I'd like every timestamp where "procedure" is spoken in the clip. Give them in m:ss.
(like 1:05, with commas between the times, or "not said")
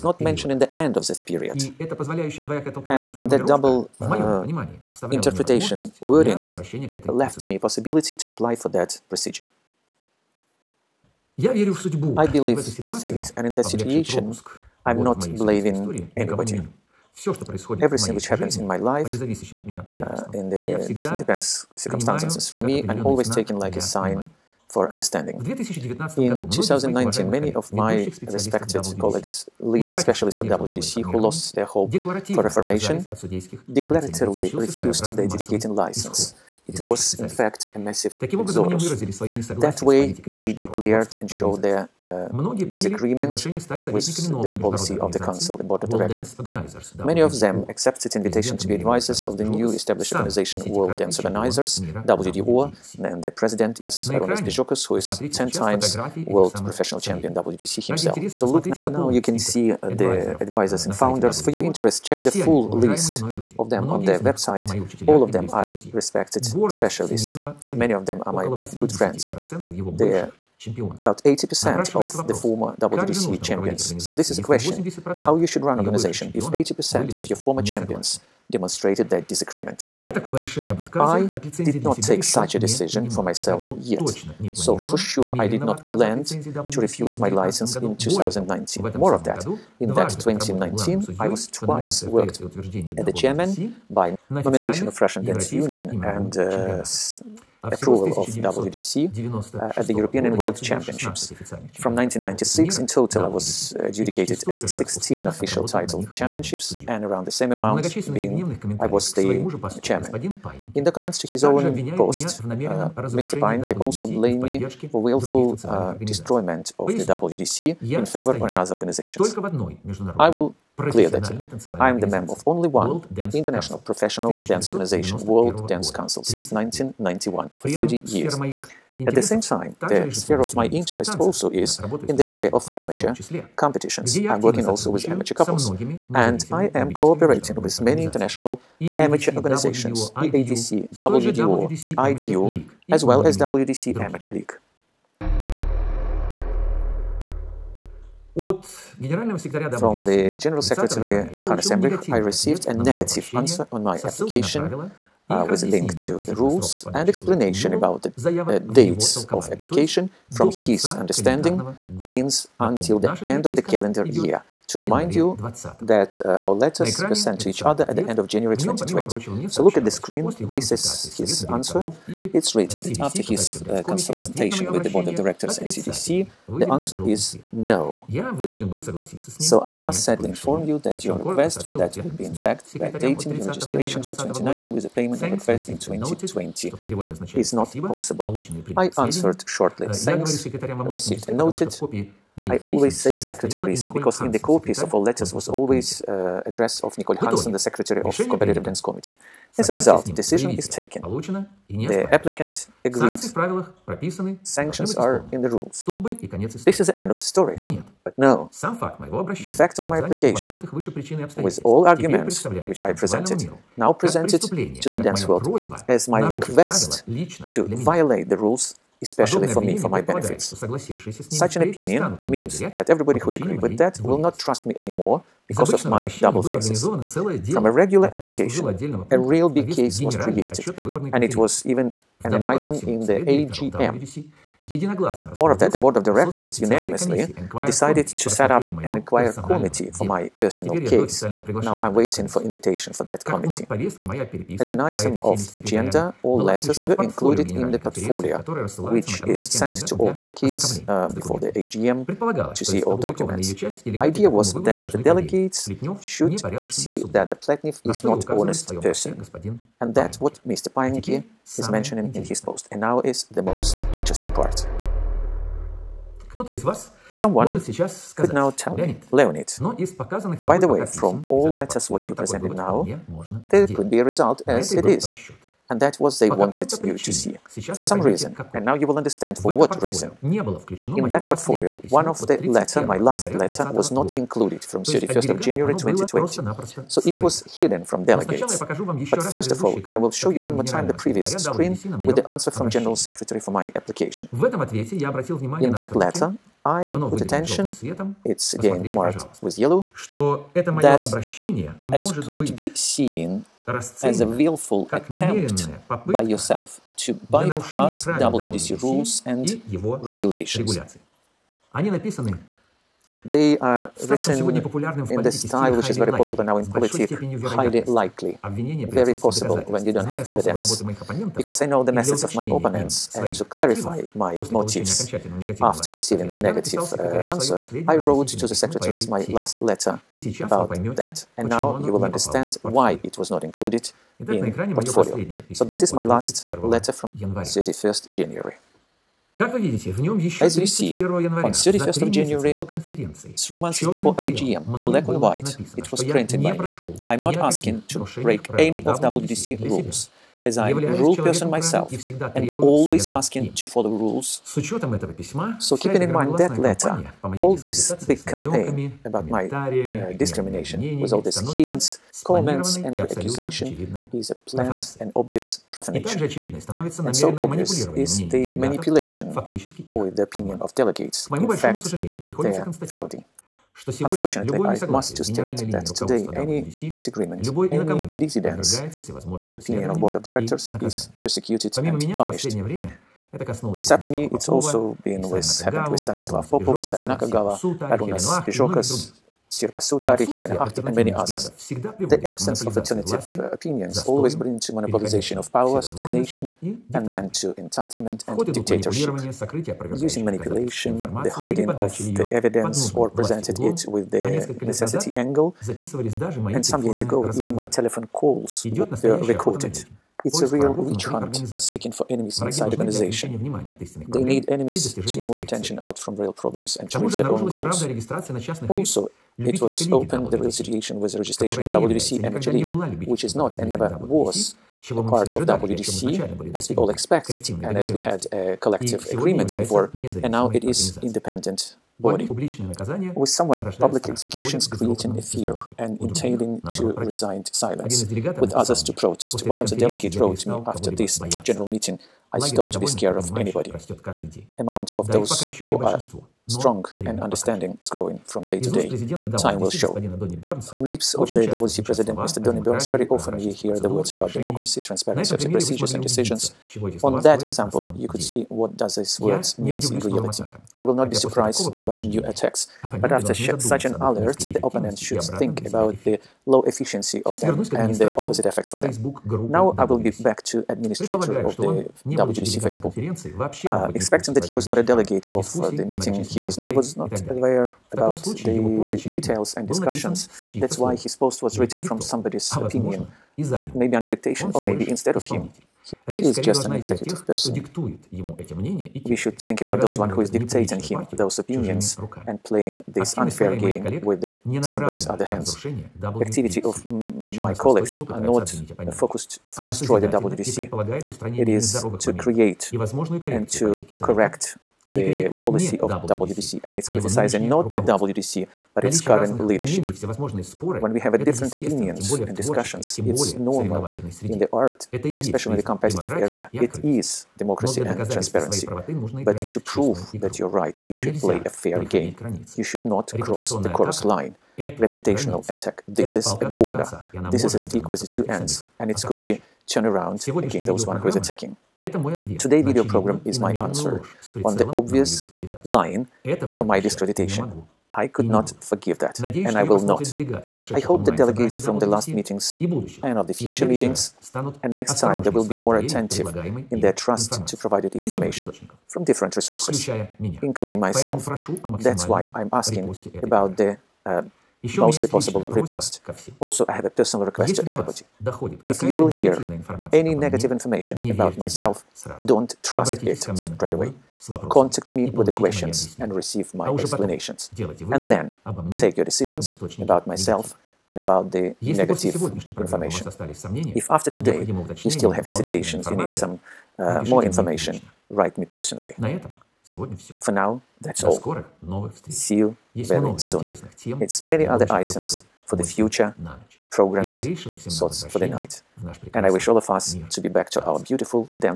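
0:09, 7:35.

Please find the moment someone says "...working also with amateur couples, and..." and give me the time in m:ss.
2:14.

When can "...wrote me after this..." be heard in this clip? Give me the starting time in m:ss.
7:20.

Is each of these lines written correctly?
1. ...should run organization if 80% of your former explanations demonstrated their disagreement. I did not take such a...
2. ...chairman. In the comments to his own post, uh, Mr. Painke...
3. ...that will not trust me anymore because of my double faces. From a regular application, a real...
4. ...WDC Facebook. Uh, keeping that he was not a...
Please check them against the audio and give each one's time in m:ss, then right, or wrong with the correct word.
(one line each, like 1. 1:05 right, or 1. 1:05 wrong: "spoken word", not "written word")
1. 1:15 wrong: "champions", not "explanations"
2. 1:49 right
3. 3:43 right
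4. 7:52 wrong: "expecting", not "keeping".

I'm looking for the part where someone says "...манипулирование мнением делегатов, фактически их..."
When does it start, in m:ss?
6:07.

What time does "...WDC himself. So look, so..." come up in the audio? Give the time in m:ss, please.
0:57.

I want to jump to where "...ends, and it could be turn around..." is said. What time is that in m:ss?
8:48.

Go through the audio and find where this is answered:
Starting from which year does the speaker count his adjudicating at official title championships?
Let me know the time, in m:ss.
1:41.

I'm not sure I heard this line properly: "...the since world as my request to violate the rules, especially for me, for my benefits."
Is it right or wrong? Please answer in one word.
wrong.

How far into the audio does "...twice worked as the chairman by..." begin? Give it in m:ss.
1:31.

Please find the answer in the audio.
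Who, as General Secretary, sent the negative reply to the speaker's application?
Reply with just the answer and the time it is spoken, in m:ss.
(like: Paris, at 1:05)
Hannes Emrich, at 2:31.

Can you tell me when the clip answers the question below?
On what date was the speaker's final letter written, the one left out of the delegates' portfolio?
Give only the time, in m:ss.
4:44.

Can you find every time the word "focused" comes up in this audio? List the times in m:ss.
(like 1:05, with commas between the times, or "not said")
8:18.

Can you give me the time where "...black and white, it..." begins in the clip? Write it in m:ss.
5:44.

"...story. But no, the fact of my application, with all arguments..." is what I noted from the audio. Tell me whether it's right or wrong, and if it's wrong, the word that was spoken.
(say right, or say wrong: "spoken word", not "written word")
right.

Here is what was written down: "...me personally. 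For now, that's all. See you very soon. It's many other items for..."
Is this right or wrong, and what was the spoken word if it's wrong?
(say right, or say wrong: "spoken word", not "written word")
right.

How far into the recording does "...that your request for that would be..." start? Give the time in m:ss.
3:00.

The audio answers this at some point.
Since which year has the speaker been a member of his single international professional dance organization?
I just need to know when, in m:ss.
2:06.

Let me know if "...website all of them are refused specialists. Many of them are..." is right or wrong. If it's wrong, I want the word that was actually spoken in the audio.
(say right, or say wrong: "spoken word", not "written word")
wrong: "respected", not "refused".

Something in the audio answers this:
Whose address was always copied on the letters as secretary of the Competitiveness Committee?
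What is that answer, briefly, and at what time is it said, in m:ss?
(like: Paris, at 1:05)
Nicole Hansen, at 3:16.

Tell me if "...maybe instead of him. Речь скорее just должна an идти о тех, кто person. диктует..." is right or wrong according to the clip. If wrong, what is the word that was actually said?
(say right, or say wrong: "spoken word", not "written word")
right.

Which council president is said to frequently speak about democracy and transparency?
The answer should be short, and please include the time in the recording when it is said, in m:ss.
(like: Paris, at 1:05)
Donnie Burns, at 7:32.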